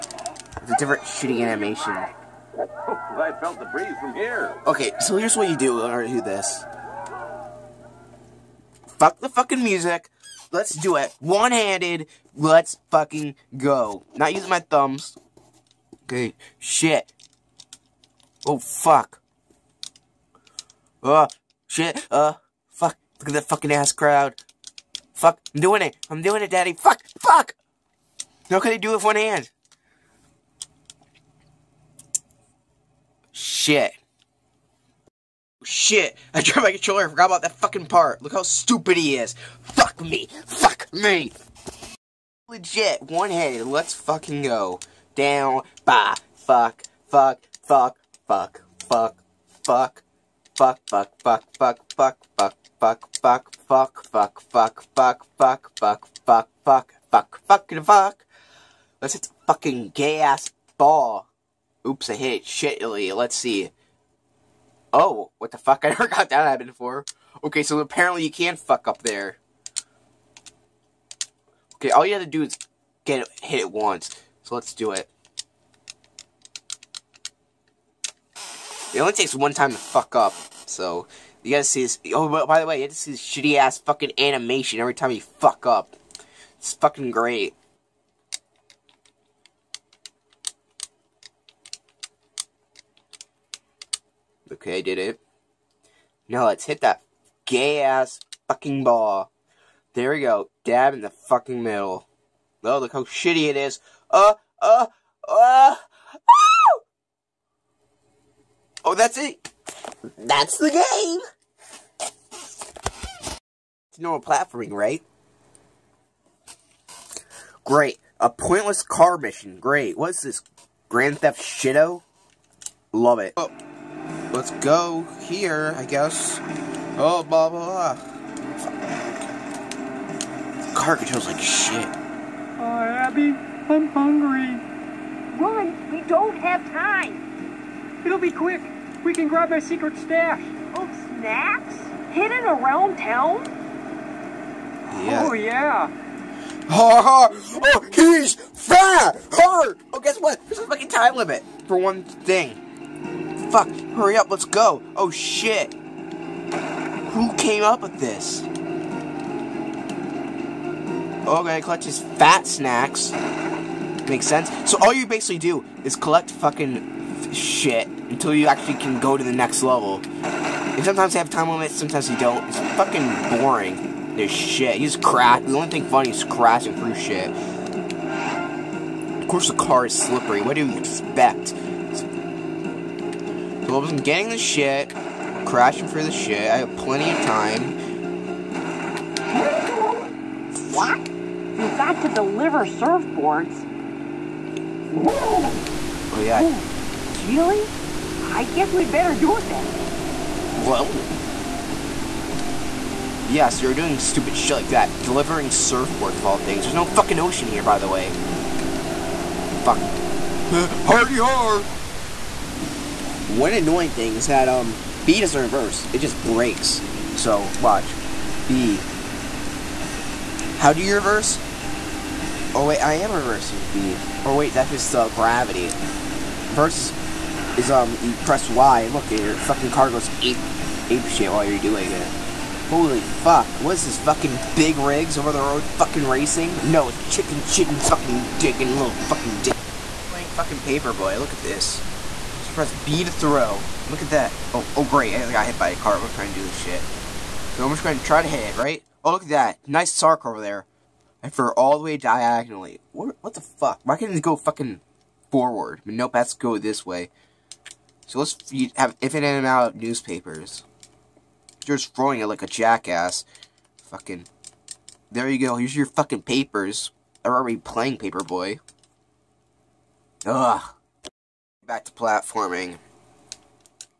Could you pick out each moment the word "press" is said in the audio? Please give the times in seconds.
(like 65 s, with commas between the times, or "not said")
228 s, 242 s.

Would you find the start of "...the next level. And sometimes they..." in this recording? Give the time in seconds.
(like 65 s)
169 s.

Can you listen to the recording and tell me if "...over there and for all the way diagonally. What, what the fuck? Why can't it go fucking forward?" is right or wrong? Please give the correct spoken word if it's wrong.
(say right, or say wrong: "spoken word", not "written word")
right.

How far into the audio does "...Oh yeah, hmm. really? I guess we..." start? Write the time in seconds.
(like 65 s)
195 s.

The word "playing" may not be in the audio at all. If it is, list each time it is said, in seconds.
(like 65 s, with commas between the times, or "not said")
240 s, 267 s.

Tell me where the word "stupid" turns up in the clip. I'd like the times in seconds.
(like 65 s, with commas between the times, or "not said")
38 s, 203 s.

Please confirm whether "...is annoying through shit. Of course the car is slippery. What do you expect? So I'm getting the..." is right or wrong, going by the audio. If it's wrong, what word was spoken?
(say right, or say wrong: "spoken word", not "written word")
wrong: "crashing", not "annoying".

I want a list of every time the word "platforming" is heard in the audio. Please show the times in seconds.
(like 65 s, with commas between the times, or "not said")
114 s, 271 s.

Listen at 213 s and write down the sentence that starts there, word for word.
One annoying thing is that, um, B doesn't reverse.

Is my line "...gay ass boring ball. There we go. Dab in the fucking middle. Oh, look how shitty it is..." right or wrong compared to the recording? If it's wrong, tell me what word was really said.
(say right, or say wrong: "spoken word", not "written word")
wrong: "fucking", not "boring".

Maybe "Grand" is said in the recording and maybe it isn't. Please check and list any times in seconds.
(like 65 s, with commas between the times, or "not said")
120 s.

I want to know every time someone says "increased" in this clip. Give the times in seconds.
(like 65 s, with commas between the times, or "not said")
not said.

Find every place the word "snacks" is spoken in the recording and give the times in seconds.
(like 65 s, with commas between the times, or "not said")
141 s, 162 s.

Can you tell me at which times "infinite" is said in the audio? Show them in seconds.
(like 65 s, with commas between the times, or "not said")
259 s.